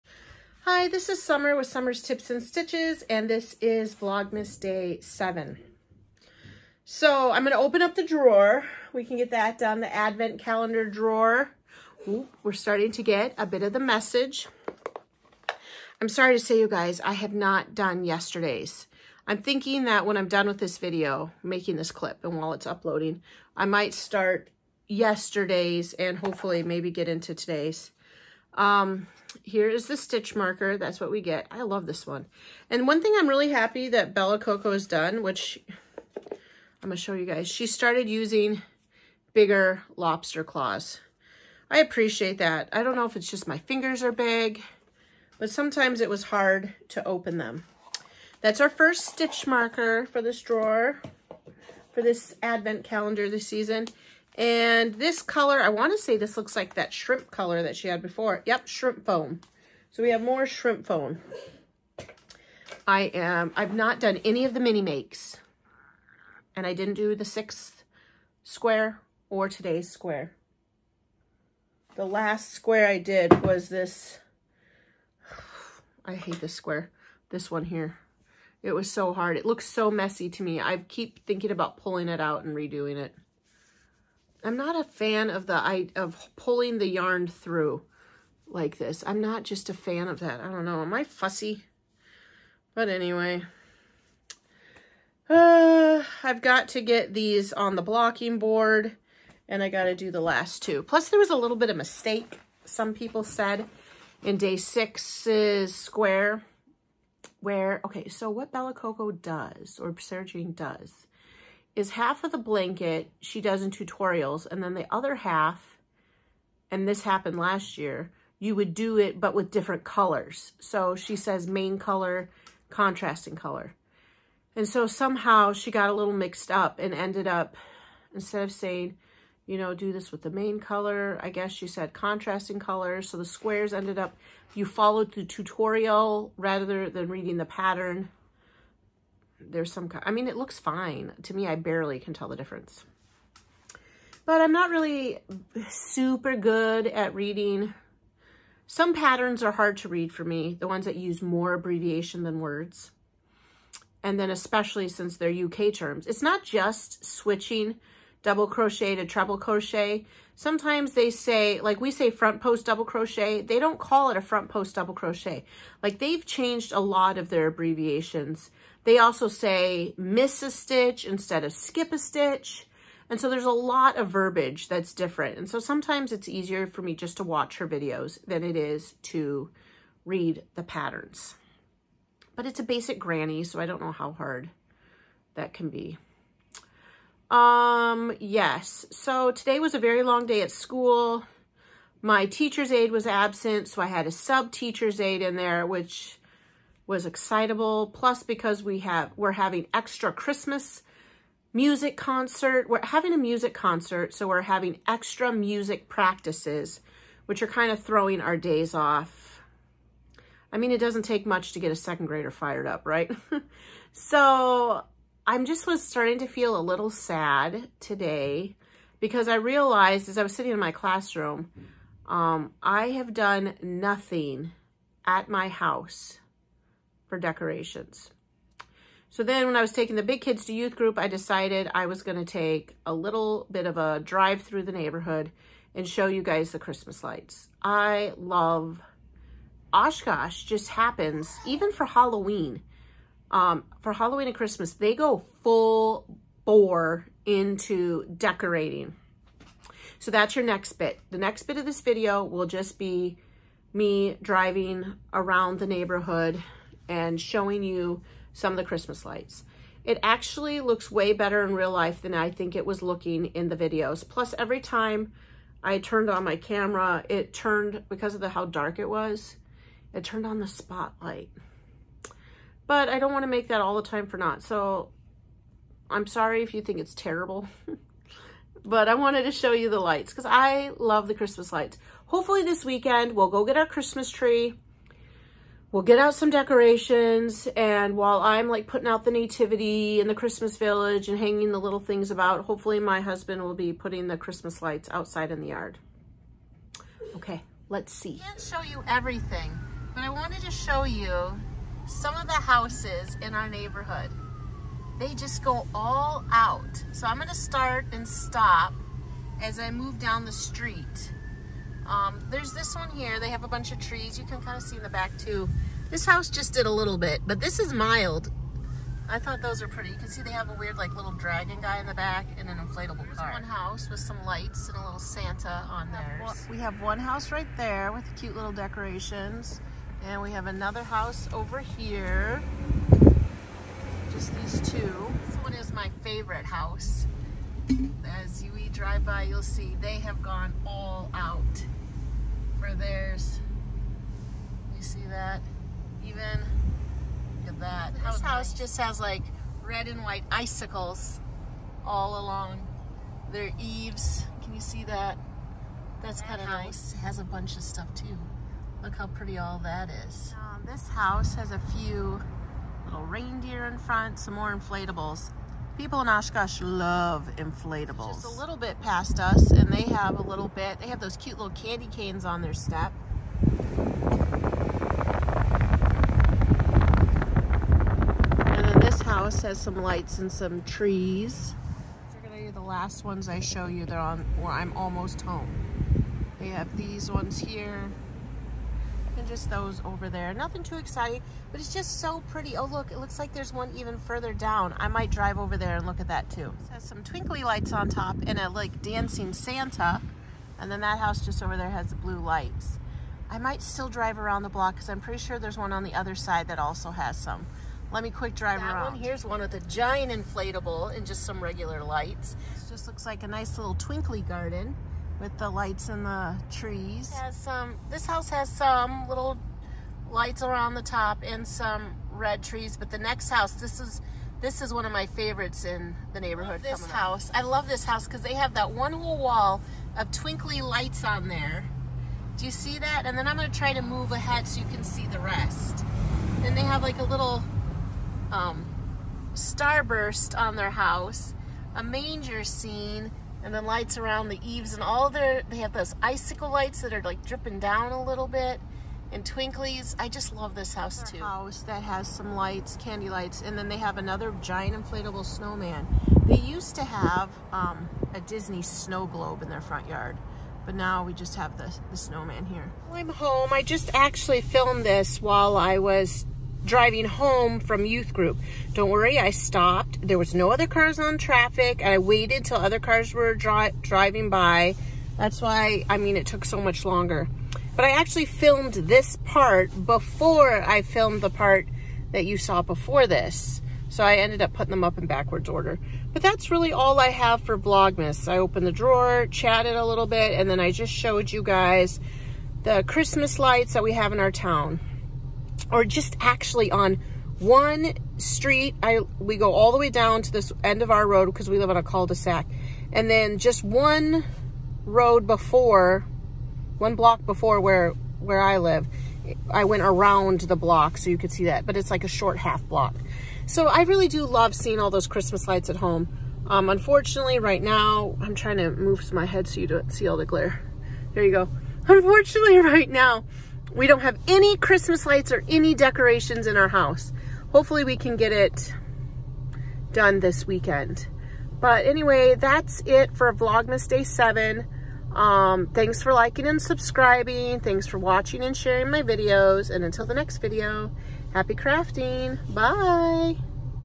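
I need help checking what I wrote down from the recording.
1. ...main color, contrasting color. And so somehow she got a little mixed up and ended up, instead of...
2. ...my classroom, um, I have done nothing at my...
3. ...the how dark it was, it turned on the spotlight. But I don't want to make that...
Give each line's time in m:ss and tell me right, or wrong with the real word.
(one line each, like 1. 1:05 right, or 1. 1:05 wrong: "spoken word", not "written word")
1. 2:01 right
2. 3:40 right
3. 4:28 right.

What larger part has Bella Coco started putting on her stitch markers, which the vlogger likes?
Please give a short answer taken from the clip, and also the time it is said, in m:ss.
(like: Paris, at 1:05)
Bigger lobster claws, at 0:39.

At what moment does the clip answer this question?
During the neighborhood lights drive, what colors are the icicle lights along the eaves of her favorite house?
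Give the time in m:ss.
5:49.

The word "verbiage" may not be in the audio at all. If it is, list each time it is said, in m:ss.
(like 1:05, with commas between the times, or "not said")
2:54.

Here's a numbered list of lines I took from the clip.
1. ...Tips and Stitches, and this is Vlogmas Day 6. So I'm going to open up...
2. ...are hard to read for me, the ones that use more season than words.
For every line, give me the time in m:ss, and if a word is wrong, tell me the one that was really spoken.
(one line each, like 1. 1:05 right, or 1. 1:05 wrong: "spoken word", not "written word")
1. 0:02 wrong: "7", not "6"
2. 2:29 wrong: "abbreviation", not "season".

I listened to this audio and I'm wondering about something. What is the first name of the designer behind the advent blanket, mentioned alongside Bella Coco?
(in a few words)
Sarah-Jayne.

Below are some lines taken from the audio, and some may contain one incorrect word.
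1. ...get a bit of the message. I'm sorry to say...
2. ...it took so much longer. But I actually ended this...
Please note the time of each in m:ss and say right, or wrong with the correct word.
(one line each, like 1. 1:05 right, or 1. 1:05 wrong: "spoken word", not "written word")
1. 0:13 right
2. 7:56 wrong: "filmed", not "ended".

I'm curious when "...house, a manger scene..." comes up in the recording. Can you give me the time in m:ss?
7:20.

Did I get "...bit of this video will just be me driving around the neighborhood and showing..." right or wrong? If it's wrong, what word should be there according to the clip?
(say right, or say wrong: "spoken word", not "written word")
right.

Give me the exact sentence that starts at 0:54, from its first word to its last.
And this color, I want to say this looks like that shrimp color that she had before.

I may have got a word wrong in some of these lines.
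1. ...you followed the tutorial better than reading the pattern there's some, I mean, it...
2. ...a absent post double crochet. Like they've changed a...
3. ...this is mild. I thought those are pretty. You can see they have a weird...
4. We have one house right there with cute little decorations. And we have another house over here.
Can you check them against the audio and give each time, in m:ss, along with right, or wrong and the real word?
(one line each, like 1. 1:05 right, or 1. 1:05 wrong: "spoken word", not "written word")
1. 2:14 wrong: "rather", not "better"
2. 2:44 wrong: "front", not "absent"
3. 5:17 right
4. 5:26 right.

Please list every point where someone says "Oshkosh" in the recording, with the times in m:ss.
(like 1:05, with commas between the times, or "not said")
3:59, 6:06.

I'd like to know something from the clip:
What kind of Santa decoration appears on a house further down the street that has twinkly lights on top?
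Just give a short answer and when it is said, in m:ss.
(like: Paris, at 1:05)
Dancing Santa, at 6:38.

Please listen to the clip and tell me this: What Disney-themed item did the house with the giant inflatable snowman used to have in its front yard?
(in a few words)
Disney snow globe.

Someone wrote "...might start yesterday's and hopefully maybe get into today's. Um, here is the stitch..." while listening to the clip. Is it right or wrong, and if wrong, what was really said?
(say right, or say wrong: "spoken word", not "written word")
right.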